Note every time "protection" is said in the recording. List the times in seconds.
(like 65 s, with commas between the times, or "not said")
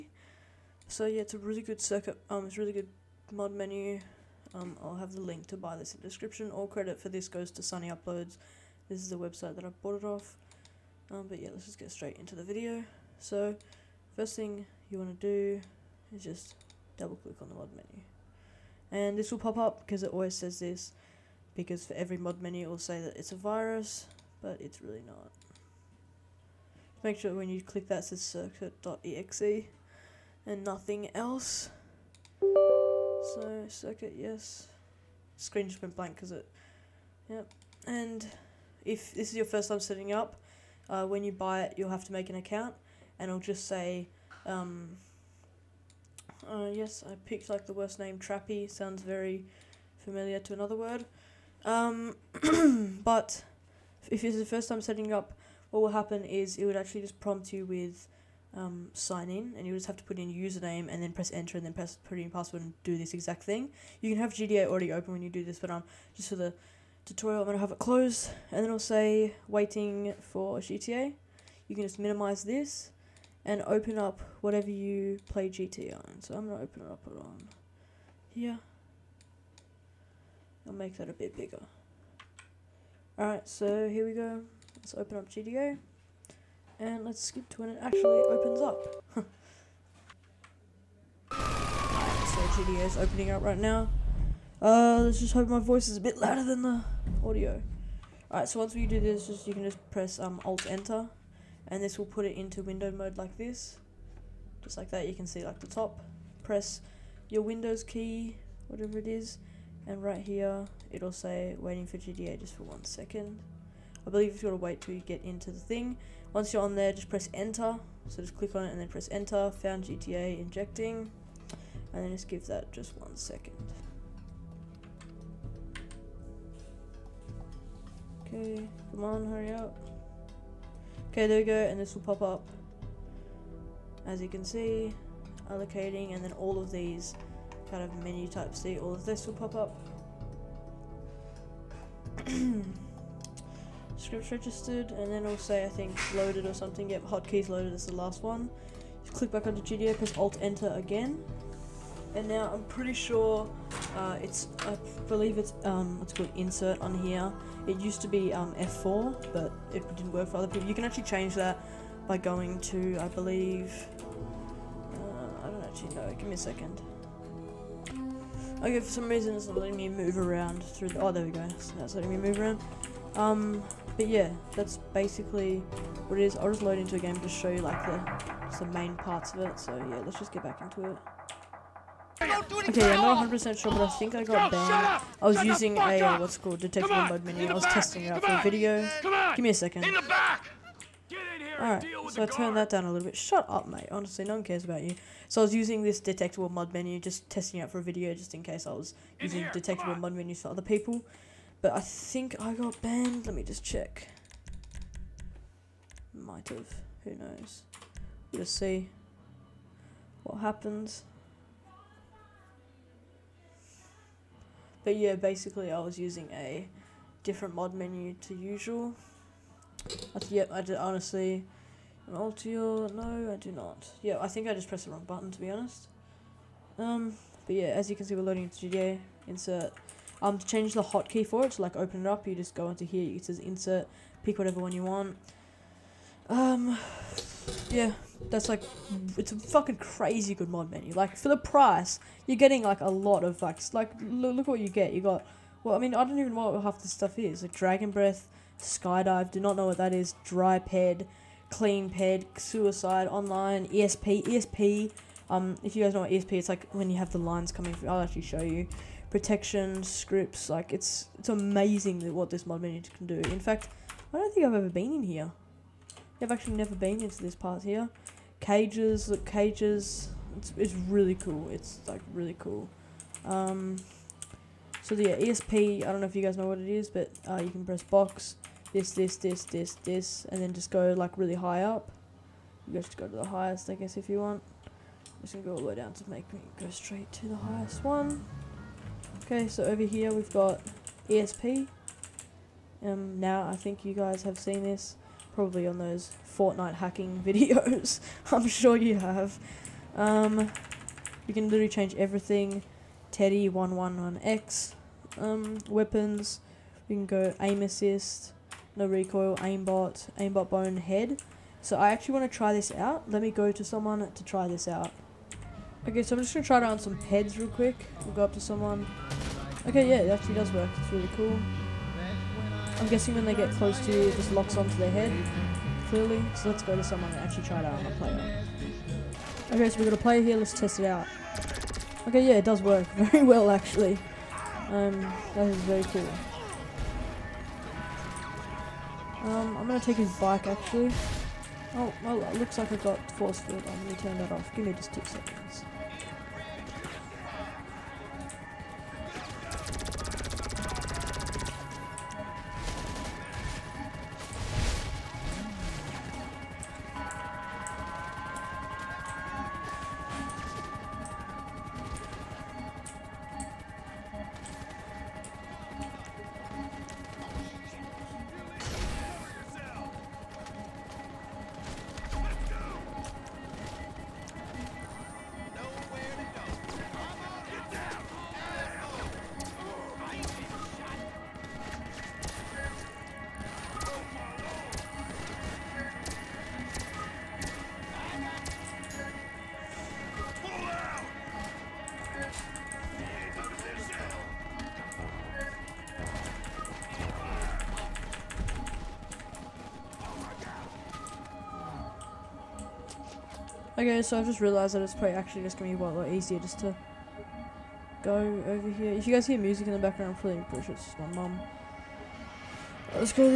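259 s.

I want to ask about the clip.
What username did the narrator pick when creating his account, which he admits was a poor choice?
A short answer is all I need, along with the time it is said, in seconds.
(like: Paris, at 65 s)
Trappy, at 48 s.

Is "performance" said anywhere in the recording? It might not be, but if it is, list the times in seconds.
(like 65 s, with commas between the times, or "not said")
not said.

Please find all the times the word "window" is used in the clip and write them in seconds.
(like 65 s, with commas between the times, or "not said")
102 s, 107 s.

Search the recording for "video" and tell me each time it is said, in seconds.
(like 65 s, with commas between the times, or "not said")
12 s, 188 s, 197 s, 297 s.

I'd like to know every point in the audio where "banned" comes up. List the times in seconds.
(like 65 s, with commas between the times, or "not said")
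184 s, 202 s.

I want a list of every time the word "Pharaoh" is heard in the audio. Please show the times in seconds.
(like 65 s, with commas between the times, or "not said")
not said.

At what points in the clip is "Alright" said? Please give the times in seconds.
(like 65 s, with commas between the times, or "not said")
83 s, 98 s, 191 s.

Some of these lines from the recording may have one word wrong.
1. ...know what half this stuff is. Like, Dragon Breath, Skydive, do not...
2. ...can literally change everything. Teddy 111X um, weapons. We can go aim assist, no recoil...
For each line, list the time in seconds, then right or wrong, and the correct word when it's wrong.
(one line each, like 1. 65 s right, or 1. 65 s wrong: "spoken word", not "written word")
1. 246 s right
2. 301 s right.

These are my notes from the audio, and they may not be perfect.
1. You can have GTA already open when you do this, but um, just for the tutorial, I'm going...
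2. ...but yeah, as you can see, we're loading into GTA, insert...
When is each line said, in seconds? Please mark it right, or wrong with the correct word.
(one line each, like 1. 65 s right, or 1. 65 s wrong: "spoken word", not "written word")
1. 63 s right
2. 227 s right.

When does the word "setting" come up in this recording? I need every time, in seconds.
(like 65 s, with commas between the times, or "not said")
39 s, 54 s.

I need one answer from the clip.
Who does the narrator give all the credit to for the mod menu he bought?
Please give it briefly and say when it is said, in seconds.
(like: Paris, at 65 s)
Sonny Uploads, at 7 s.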